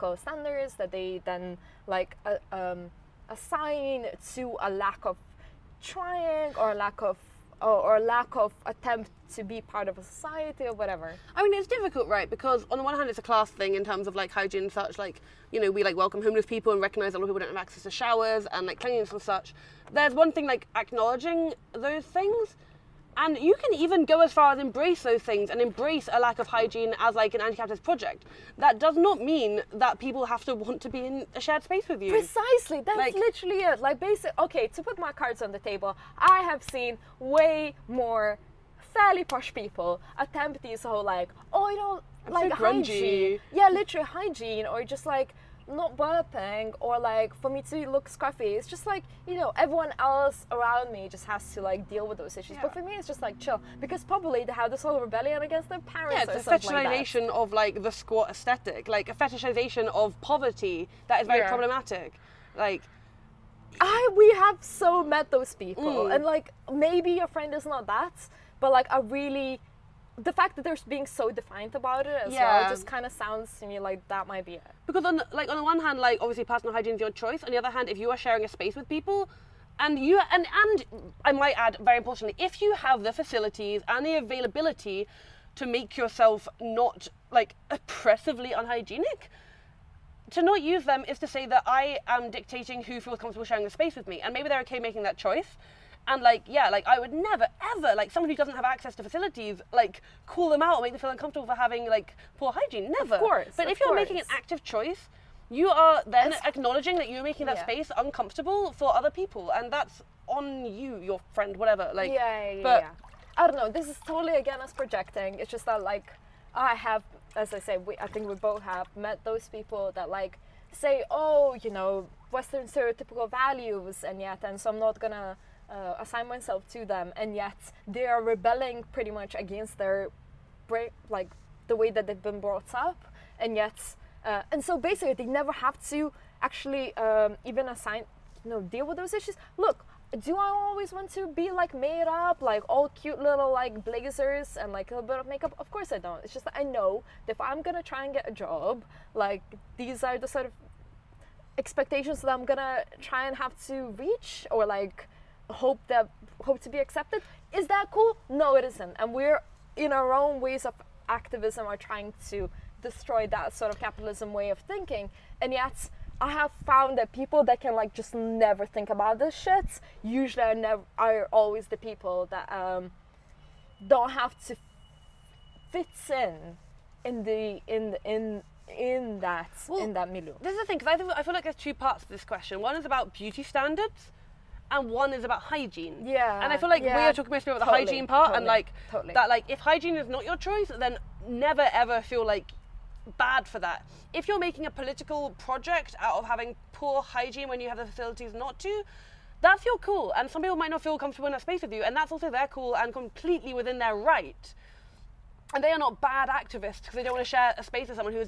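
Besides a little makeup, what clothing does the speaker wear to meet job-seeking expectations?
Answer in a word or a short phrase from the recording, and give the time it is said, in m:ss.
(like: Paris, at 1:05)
Blazers, at 2:23.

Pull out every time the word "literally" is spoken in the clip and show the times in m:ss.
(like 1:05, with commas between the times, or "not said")
0:33, 0:43.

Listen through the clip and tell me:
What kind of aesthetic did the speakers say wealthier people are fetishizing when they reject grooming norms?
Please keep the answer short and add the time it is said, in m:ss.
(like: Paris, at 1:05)
The squat aesthetic, at 0:57.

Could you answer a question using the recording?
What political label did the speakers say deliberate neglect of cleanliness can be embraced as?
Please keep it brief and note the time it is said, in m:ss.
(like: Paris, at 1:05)
An anti-capitalist project, at 0:27.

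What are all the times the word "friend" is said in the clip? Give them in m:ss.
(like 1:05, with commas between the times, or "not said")
1:07, 1:51.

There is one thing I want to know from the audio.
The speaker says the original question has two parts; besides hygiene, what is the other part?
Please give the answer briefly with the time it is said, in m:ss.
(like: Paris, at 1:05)
Beauty standards, at 3:03.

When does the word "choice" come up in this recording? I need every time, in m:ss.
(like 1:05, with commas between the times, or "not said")
1:17, 1:35, 1:44, 3:10.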